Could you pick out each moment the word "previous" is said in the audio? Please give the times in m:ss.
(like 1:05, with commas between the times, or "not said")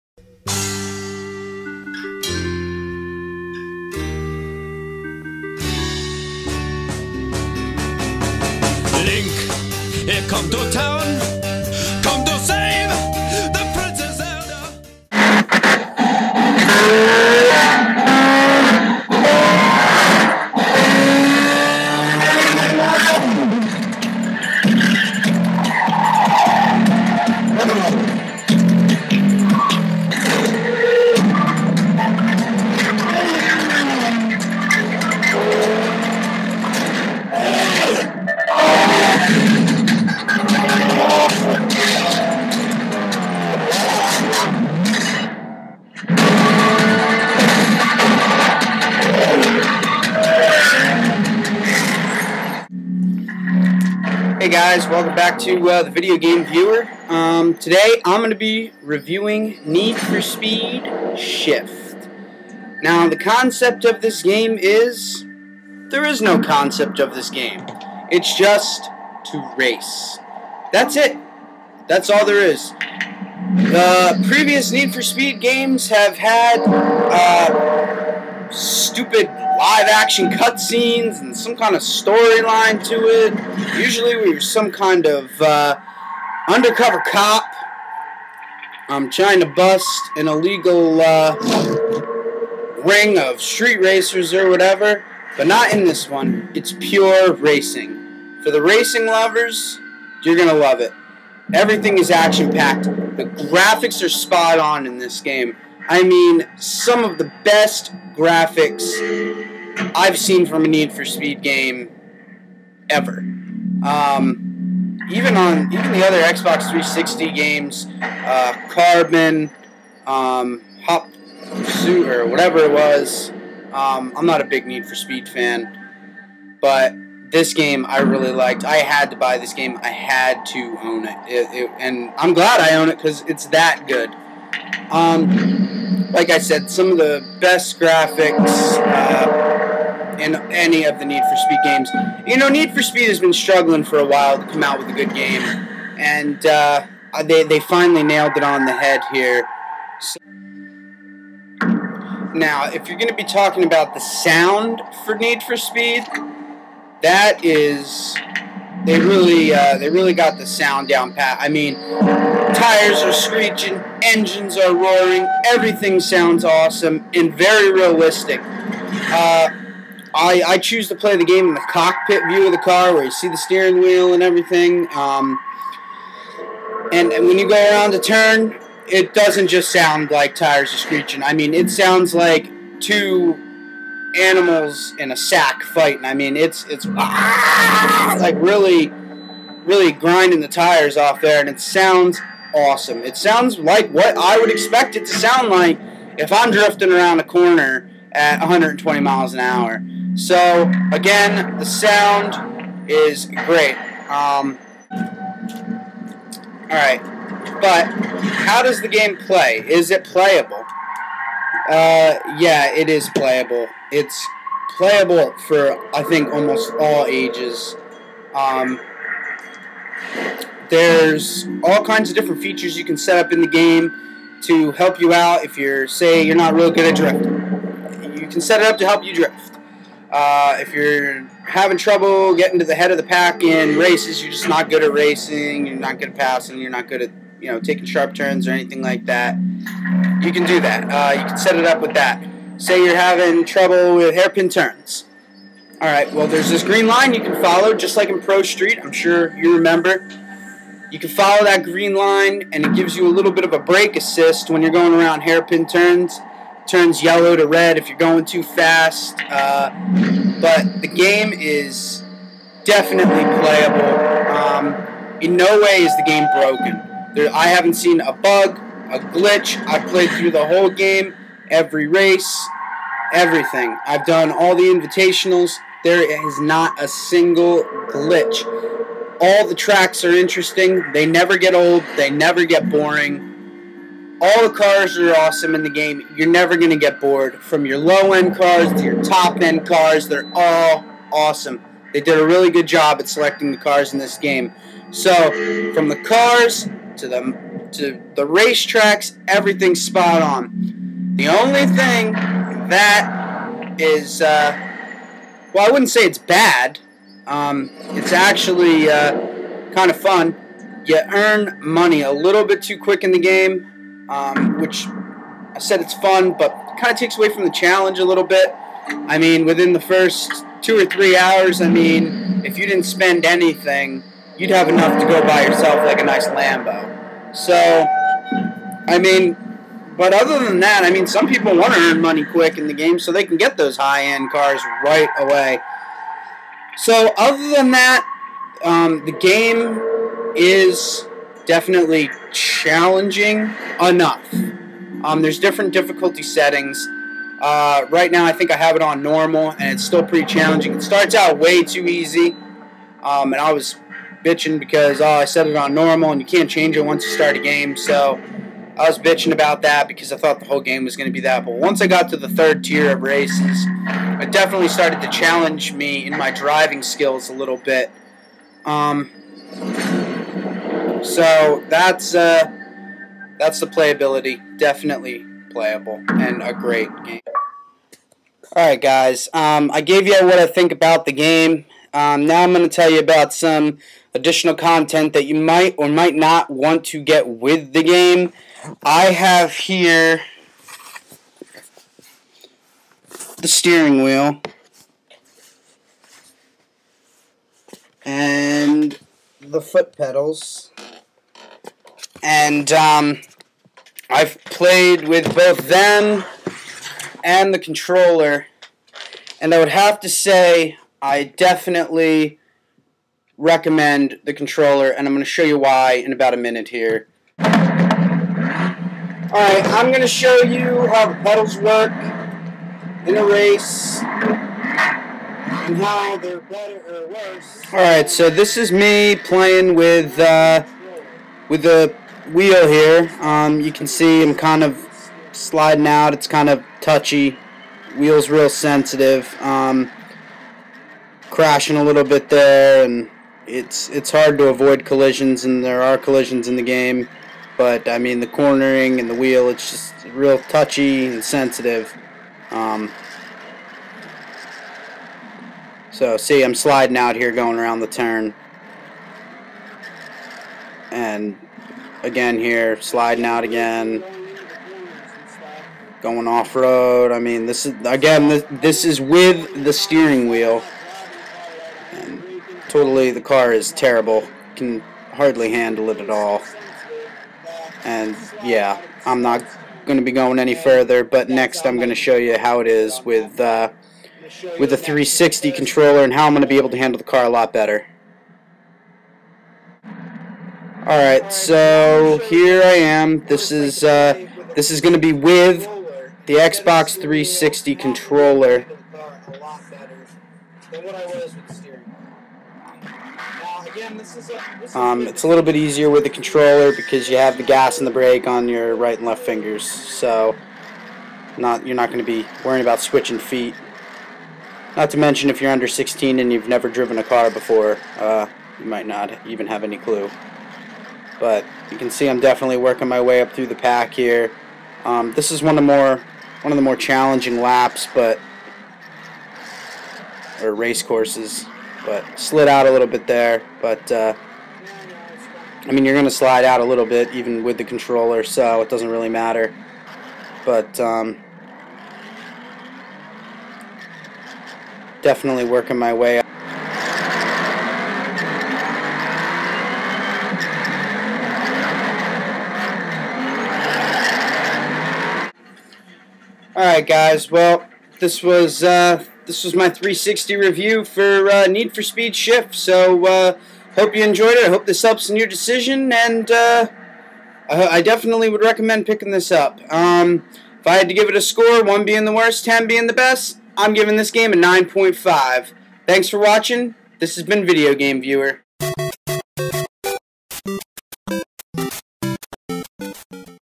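1:14.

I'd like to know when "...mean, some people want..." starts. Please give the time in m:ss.
5:30.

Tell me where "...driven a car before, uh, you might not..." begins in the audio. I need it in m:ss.
8:36.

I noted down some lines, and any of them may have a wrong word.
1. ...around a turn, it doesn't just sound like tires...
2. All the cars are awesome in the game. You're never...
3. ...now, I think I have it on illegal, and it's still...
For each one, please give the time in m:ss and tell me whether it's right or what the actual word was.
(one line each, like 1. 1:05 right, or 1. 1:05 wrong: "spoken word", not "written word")
1. 2:57 right
2. 4:44 right
3. 5:48 wrong: "normal", not "illegal".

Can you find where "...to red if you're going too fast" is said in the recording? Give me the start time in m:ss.
4:17.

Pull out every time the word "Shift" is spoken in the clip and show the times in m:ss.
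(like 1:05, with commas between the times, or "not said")
1:01, 9:22.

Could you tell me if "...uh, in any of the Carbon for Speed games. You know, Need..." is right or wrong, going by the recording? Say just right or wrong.
wrong.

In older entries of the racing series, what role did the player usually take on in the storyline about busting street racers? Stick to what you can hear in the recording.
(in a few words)
Undercover cop.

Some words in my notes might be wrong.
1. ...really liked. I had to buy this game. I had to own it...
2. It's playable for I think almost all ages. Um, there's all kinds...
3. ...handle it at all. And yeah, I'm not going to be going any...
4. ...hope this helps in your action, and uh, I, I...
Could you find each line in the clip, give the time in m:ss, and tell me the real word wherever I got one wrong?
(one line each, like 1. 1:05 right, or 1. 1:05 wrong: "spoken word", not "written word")
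1. 2:07 right
2. 3:33 right
3. 7:55 right
4. 9:24 wrong: "decision", not "action".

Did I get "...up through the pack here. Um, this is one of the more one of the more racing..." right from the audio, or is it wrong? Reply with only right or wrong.
wrong.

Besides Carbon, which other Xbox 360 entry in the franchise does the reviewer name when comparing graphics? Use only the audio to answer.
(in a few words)
Hot Pursuit.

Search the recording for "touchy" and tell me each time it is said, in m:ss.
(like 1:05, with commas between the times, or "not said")
7:16, 7:30.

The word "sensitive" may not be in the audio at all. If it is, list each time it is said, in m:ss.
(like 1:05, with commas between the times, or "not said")
7:18, 7:31.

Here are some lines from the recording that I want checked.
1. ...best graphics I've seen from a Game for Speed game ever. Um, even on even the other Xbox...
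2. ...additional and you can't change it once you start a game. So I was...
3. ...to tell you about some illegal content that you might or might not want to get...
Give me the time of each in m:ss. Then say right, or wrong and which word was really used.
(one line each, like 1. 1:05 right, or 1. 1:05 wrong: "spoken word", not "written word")
1. 1:47 wrong: "Need", not "Game"
2. 5:55 wrong: "normal", not "additional"
3. 6:22 wrong: "additional", not "illegal".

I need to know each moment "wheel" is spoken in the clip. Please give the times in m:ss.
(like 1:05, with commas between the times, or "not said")
2:53, 6:34, 7:12, 7:17, 7:29, 7:50.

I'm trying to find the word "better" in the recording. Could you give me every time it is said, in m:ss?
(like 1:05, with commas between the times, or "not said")
7:06, 8:07.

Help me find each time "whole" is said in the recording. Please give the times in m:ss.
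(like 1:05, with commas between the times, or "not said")
4:30, 6:00.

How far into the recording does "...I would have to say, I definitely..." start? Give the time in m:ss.
6:49.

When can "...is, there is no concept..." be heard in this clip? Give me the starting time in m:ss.
1:04.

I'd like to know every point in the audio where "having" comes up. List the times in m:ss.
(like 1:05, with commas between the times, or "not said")
3:51, 4:02.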